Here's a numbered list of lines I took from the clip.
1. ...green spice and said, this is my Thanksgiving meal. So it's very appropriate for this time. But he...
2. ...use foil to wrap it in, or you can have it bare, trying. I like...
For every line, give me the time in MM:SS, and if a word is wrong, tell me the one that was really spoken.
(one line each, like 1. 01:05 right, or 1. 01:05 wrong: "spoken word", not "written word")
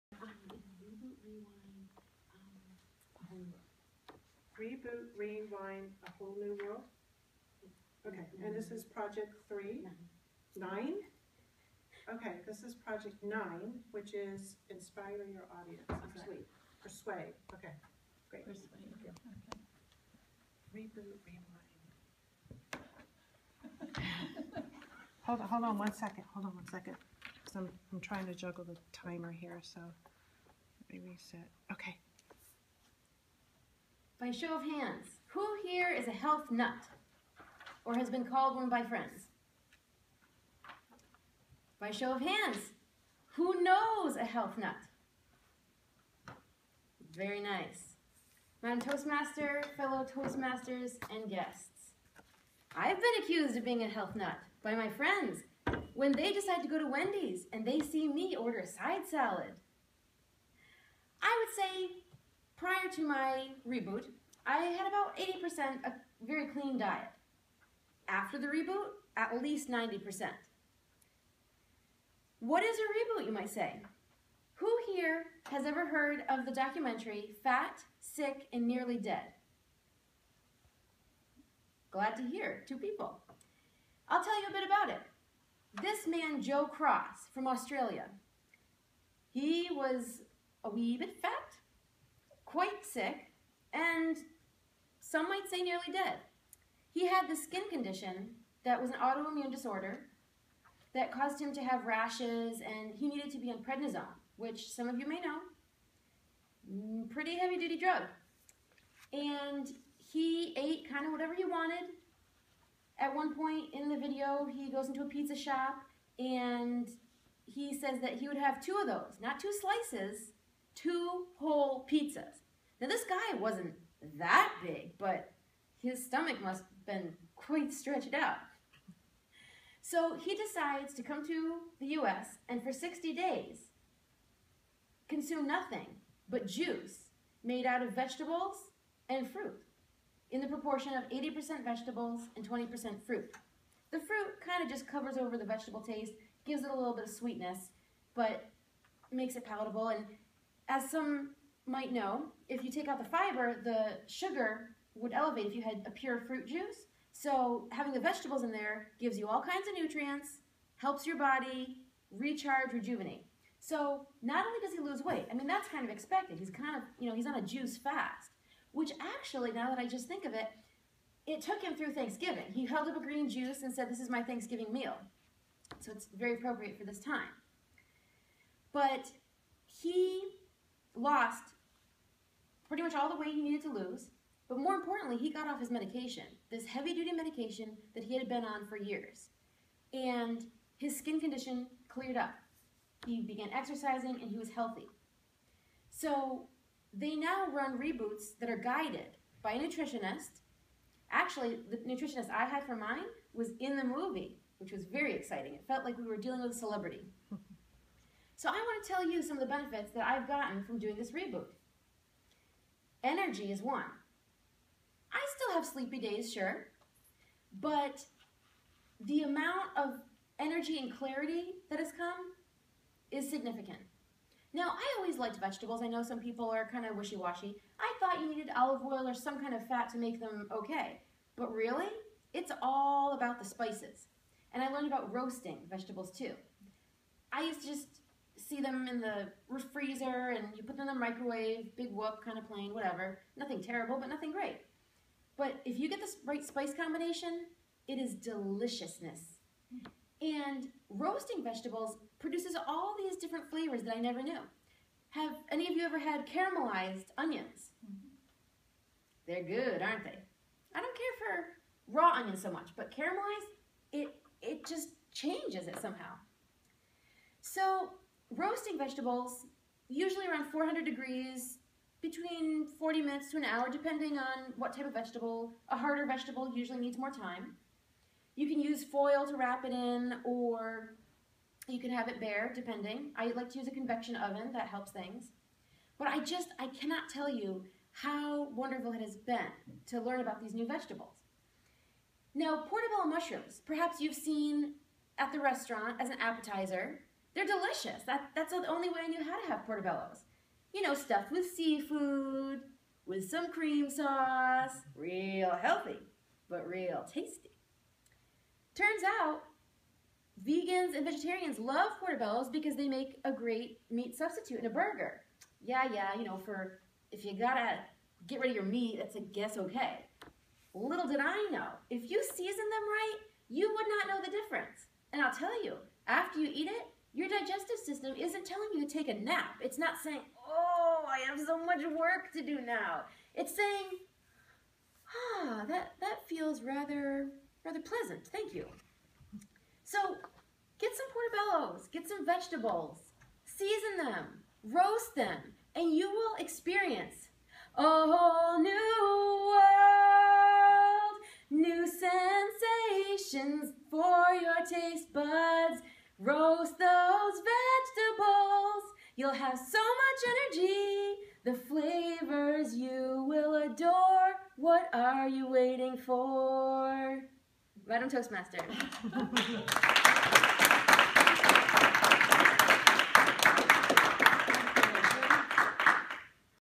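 1. 02:53 wrong: "juice", not "spice"
2. 04:38 wrong: "depending", not "trying".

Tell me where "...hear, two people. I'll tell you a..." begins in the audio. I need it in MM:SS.
01:22.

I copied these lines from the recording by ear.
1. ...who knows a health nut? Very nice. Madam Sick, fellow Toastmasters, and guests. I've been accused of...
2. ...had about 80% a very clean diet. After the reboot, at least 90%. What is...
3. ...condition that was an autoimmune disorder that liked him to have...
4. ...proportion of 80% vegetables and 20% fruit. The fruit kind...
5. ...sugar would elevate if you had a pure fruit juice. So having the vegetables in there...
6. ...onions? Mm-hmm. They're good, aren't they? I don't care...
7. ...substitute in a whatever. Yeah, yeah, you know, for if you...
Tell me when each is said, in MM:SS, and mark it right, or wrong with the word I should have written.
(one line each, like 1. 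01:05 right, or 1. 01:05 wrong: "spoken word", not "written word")
1. 00:43 wrong: "Toastmaster", not "Sick"
2. 01:04 right
3. 01:37 wrong: "caused", not "liked"
4. 02:20 right
5. 02:34 right
6. 04:17 right
7. 05:14 wrong: "burger", not "whatever".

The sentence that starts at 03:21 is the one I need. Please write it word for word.
Actually, the nutritionist I had for mine was in the movie, which was very exciting.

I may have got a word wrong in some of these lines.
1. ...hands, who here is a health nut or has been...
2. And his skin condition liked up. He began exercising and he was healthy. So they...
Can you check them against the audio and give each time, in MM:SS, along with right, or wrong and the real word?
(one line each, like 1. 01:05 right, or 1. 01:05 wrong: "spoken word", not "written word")
1. 00:34 right
2. 03:09 wrong: "cleared", not "liked".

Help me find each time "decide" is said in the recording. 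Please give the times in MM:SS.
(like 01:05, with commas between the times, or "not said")
00:56, 02:10.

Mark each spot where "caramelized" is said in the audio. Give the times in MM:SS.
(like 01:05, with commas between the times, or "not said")
04:16, 04:22.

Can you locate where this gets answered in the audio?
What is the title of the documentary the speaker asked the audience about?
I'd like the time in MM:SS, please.
01:17.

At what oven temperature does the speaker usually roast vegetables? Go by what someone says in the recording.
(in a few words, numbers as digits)
400 degrees.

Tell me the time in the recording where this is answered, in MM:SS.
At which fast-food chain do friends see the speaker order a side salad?
00:56.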